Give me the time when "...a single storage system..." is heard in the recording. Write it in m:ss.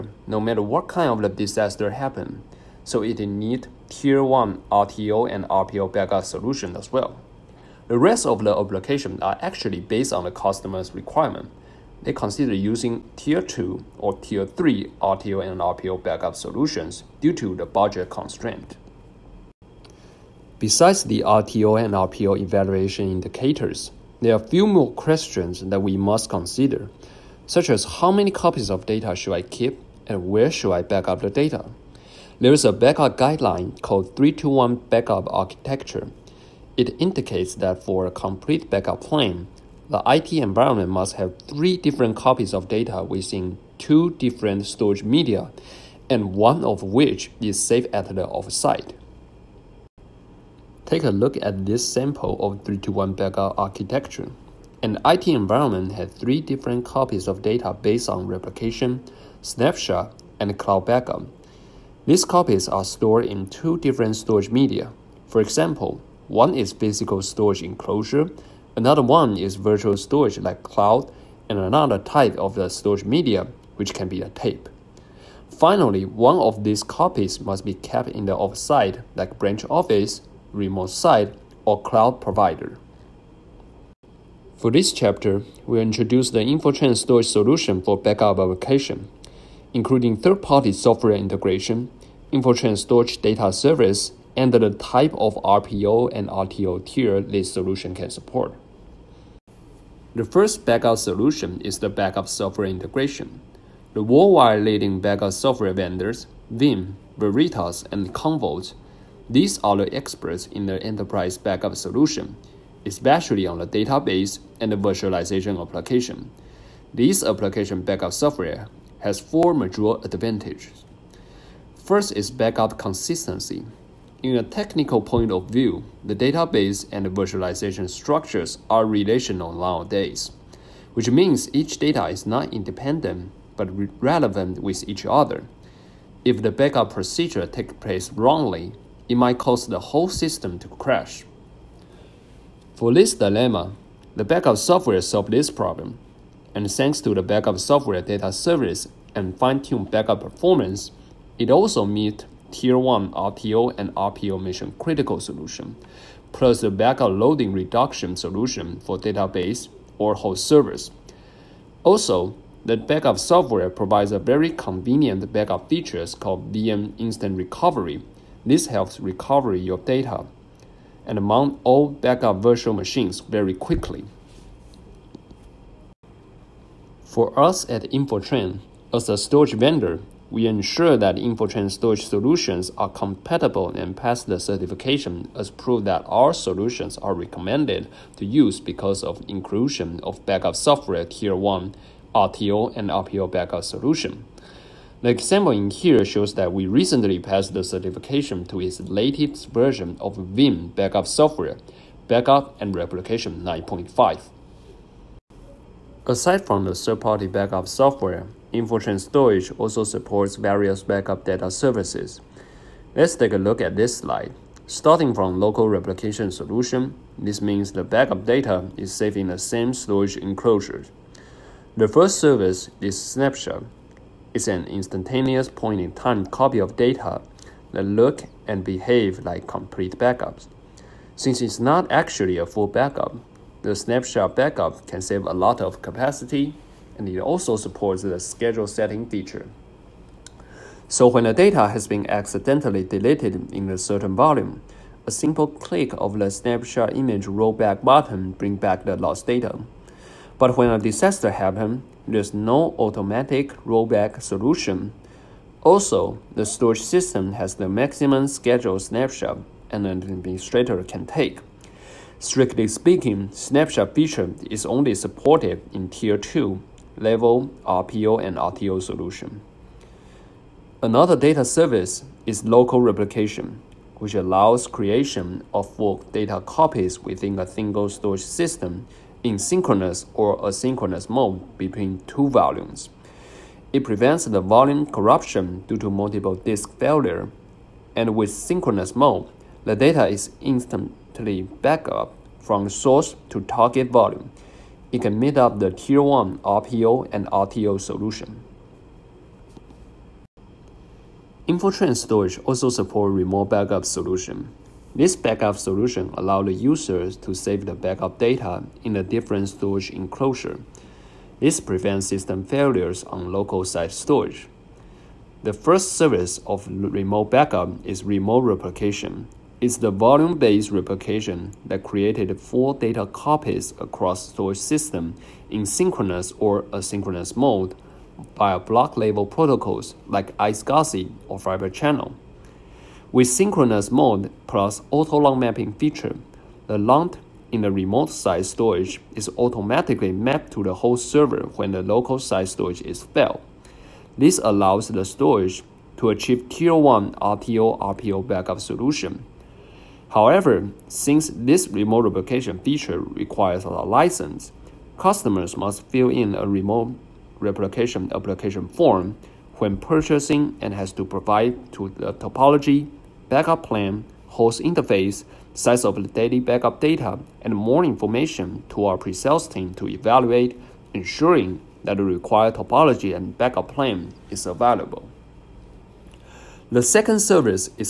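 4:37.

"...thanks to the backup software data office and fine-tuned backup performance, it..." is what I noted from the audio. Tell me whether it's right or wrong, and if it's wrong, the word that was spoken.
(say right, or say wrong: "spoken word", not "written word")
wrong: "service", not "office".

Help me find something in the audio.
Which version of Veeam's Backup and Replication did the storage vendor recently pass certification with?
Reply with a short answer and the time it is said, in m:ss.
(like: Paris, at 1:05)
9.5, at 3:23.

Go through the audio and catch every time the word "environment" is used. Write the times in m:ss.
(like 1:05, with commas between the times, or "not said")
0:40, 0:55.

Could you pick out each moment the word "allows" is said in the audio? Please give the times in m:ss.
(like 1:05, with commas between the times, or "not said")
4:34, 5:06, 5:44.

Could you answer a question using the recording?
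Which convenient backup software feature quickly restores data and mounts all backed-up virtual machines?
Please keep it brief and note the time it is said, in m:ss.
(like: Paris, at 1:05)
VM Instant Recovery, at 2:46.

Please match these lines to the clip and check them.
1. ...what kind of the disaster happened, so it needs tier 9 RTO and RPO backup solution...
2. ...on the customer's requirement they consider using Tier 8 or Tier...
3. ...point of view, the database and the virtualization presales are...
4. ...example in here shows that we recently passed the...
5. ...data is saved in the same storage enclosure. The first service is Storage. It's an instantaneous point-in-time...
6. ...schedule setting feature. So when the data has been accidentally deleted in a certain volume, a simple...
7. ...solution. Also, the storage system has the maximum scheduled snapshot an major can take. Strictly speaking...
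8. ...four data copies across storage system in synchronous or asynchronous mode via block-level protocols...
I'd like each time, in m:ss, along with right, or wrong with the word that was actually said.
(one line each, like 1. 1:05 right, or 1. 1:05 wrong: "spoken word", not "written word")
1. 0:00 wrong: "1", not "9"
2. 0:10 wrong: "2", not "8"
3. 2:05 wrong: "structures", not "presales"
4. 3:15 right
5. 3:38 wrong: "Snapshot", not "Storage"
6. 3:58 right
7. 4:14 wrong: "administrator", not "major"
8. 5:22 right.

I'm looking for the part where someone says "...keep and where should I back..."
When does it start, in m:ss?
0:29.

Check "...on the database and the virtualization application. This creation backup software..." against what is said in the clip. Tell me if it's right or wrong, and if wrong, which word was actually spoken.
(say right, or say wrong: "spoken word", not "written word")
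wrong: "application", not "creation".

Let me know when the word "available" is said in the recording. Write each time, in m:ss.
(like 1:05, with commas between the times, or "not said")
6:14.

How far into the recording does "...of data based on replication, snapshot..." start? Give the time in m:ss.
0:57.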